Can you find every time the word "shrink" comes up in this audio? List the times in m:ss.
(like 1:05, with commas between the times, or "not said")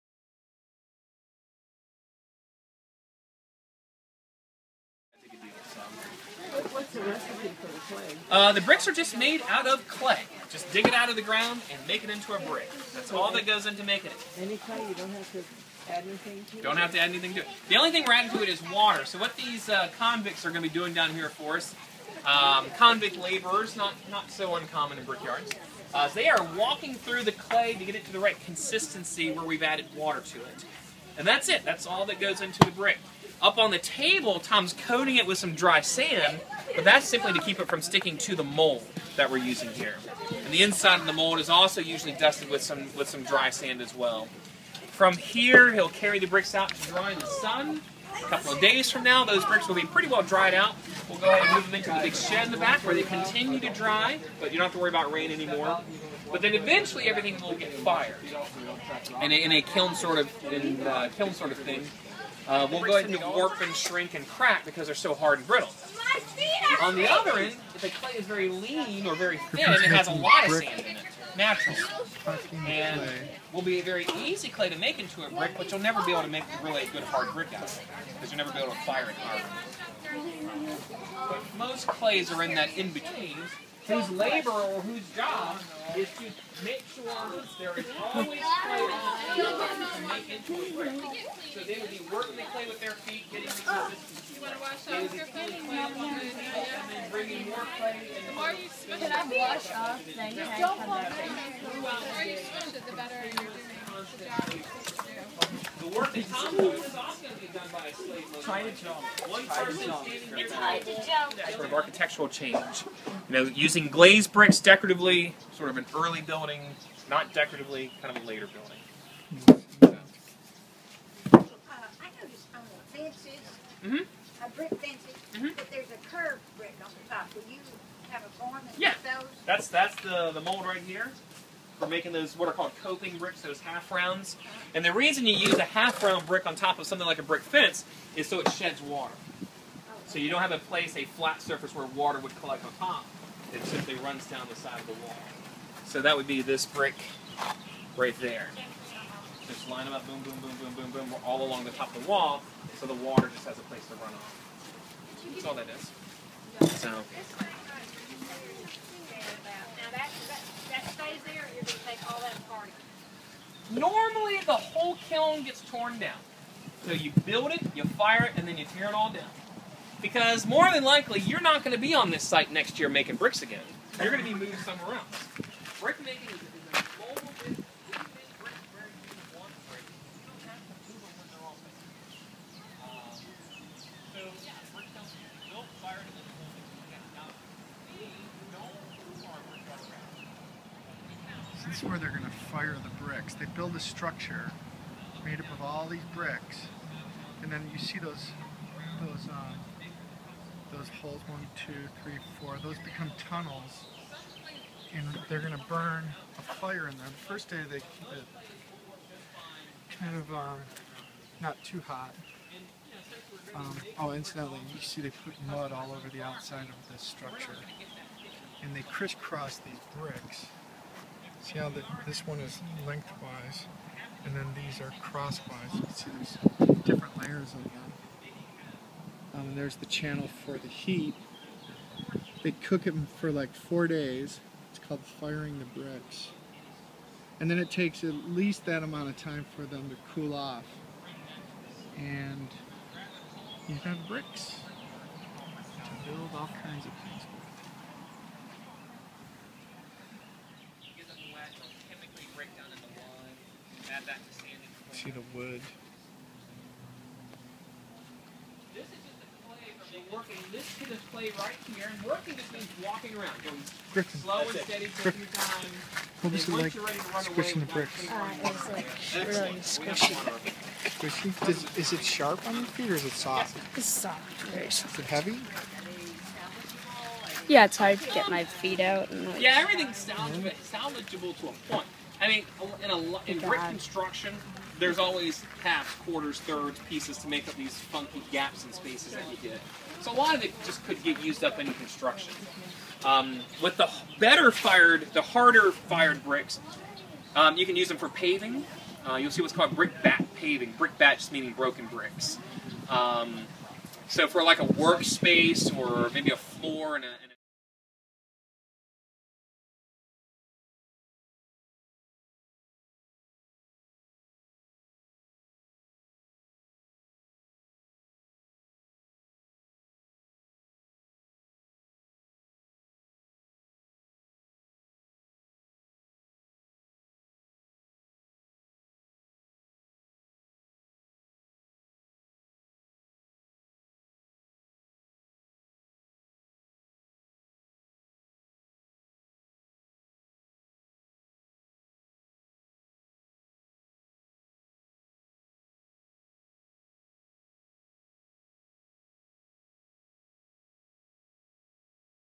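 1:03.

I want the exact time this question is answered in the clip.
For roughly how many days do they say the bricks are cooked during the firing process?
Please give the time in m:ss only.
3:53.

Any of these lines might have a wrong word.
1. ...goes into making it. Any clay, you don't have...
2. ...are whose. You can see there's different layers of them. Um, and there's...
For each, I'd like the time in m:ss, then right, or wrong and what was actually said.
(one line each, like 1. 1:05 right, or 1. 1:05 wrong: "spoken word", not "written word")
1. 0:13 right
2. 3:44 wrong: "crosswise", not "whose".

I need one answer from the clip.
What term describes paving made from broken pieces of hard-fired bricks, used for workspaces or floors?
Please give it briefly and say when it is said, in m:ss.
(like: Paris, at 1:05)
Brickbat paving, at 4:59.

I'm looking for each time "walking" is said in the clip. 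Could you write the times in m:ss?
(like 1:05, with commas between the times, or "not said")
0:26, 4:22.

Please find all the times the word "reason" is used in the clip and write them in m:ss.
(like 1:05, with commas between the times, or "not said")
2:14.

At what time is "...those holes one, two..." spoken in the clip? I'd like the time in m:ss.
3:20.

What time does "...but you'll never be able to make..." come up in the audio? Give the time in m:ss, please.
1:15.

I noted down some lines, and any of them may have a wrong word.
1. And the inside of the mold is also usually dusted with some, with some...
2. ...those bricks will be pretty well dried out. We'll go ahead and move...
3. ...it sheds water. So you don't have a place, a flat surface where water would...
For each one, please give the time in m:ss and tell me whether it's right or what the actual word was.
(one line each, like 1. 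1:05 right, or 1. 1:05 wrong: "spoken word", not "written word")
1. 0:40 right
2. 0:49 right
3. 2:18 right.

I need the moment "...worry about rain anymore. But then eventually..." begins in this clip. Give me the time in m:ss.
0:54.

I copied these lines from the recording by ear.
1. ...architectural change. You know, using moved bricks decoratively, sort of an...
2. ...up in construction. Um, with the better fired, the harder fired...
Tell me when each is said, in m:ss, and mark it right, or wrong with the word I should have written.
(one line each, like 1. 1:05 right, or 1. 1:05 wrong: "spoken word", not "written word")
1. 1:51 wrong: "glazed", not "moved"
2. 4:51 right.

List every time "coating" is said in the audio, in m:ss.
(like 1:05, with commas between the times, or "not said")
0:34.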